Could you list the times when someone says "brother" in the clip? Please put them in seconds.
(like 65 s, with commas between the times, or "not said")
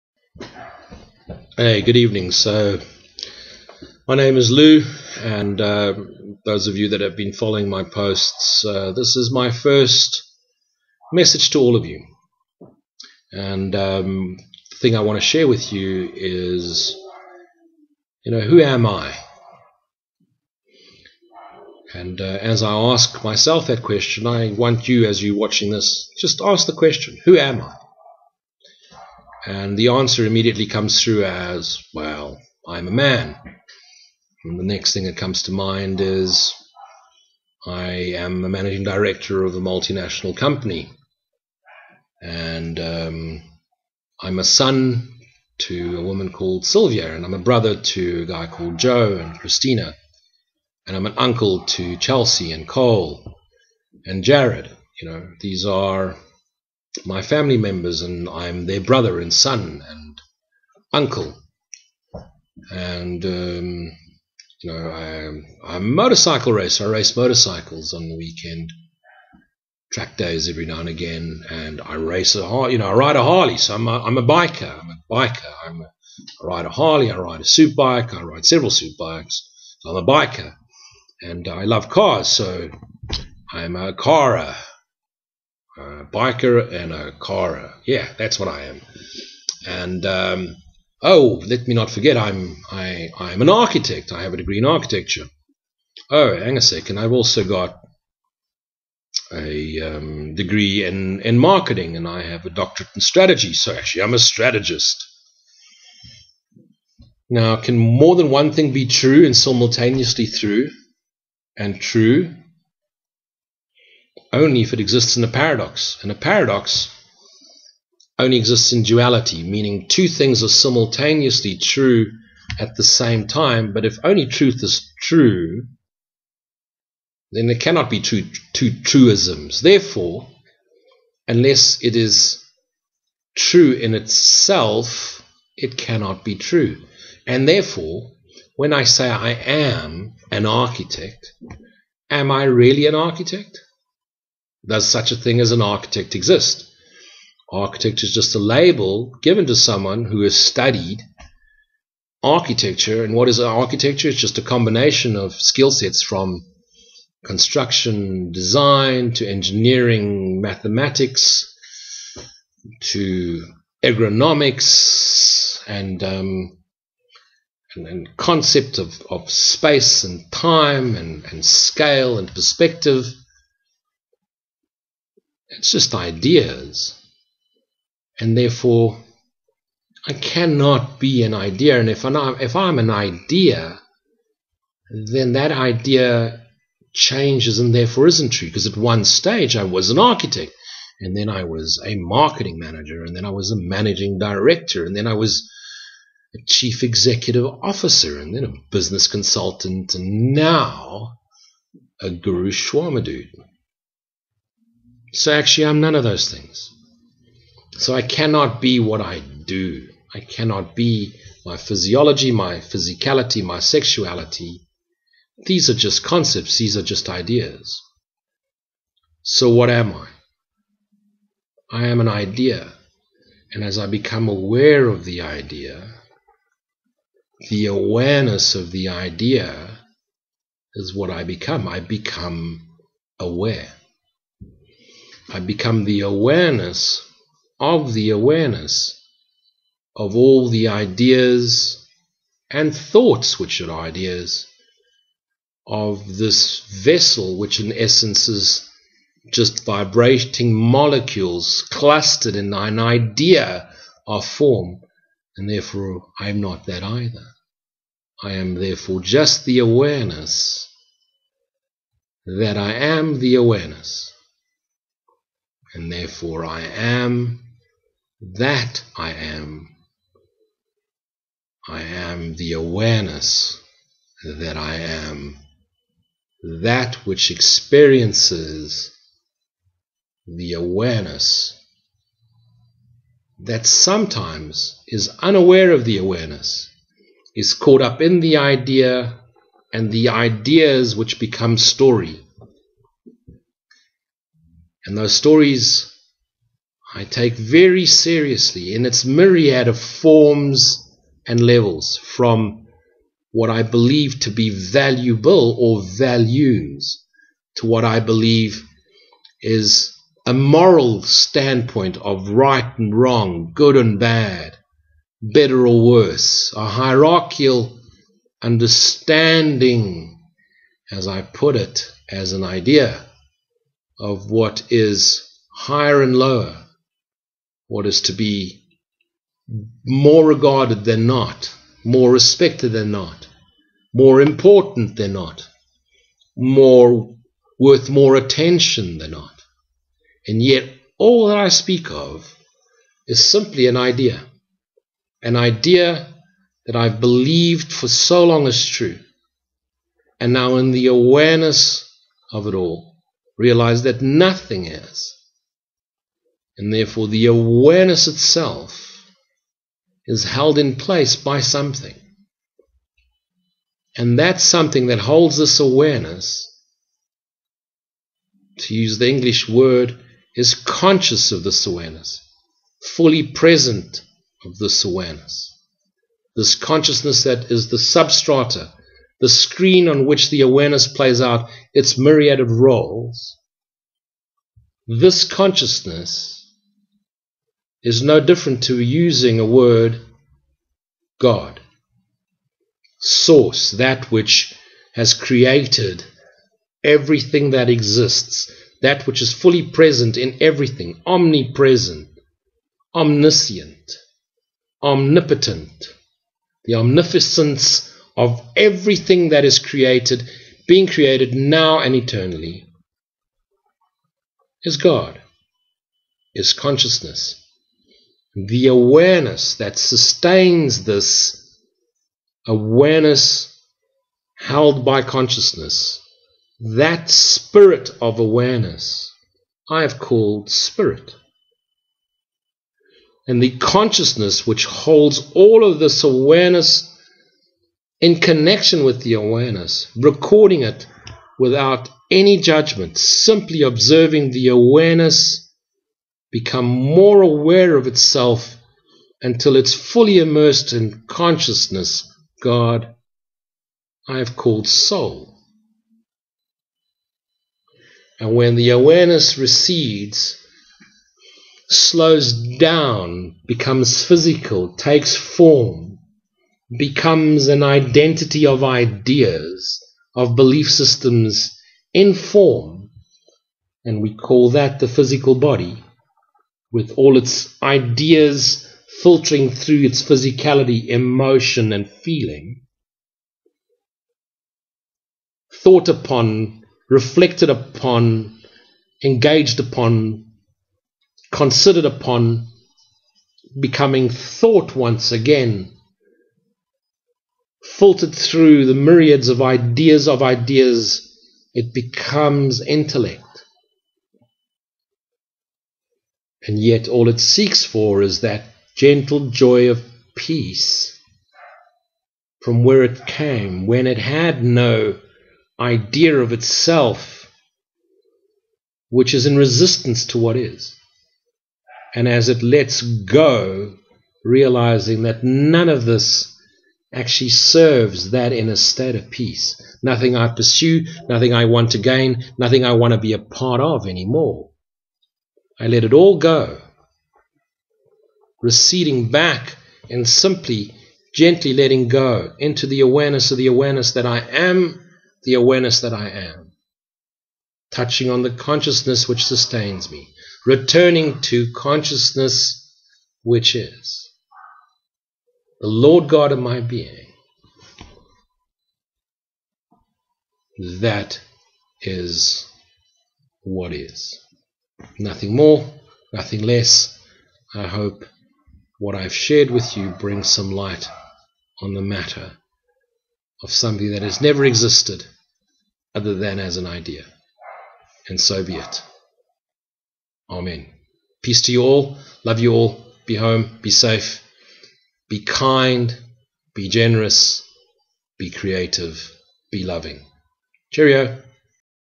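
47 s, 58 s.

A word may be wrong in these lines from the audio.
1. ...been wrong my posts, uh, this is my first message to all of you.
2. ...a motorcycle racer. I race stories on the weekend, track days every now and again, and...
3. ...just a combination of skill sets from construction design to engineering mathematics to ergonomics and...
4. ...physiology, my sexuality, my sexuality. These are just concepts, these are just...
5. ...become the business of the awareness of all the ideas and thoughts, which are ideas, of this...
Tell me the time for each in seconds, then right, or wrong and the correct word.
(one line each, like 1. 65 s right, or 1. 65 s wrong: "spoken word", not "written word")
1. 7 s wrong: "following", not "wrong"
2. 65 s wrong: "motorcycles", not "stories"
3. 154 s right
4. 211 s wrong: "physicality", not "sexuality"
5. 235 s wrong: "awareness", not "business".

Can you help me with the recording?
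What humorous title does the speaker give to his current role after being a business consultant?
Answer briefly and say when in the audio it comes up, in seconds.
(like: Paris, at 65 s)
Guru Shwama dude, at 202 s.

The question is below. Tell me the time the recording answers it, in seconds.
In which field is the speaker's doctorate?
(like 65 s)
103 s.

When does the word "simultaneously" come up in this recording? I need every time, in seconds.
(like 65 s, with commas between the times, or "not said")
109 s, 120 s.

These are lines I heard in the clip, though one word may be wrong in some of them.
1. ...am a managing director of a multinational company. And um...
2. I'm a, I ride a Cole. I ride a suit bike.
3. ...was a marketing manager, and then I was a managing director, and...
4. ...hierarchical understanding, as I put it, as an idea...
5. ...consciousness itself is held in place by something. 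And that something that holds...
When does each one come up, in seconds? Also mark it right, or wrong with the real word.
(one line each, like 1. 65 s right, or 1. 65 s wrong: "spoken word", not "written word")
1. 38 s right
2. 75 s wrong: "Harley", not "Cole"
3. 191 s right
4. 316 s right
5. 357 s wrong: "awareness", not "consciousness".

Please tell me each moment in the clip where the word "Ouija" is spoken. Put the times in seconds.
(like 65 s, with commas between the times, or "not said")
not said.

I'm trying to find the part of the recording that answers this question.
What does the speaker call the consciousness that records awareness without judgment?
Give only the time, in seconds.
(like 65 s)
454 s.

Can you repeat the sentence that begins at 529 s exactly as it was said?
Nothing I pursue, nothing I want to gain, nothing I want to be a part of anymore.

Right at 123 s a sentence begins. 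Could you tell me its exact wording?
But if only truth is true, then there cannot be two, two truisms.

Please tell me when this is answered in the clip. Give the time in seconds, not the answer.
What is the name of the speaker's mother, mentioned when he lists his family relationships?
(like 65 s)
46 s.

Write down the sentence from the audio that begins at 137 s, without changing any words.
And therefore, when I say I am an architect, am I really an architect?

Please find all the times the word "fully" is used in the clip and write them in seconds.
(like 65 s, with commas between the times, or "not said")
372 s, 399 s, 449 s.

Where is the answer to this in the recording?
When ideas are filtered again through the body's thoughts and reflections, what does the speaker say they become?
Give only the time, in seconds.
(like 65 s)
502 s.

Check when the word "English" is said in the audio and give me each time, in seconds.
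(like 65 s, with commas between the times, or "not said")
369 s.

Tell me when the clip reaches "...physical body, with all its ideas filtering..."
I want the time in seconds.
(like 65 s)
474 s.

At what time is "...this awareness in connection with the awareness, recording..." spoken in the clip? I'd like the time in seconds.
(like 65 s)
435 s.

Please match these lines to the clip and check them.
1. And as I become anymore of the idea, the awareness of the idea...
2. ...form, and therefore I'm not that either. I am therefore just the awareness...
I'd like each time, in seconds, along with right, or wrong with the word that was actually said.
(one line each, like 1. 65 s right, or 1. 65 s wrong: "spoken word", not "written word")
1. 223 s wrong: "aware", not "anymore"
2. 254 s right.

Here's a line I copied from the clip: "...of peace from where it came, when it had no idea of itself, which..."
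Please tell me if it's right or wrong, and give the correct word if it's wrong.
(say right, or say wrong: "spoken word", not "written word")
right.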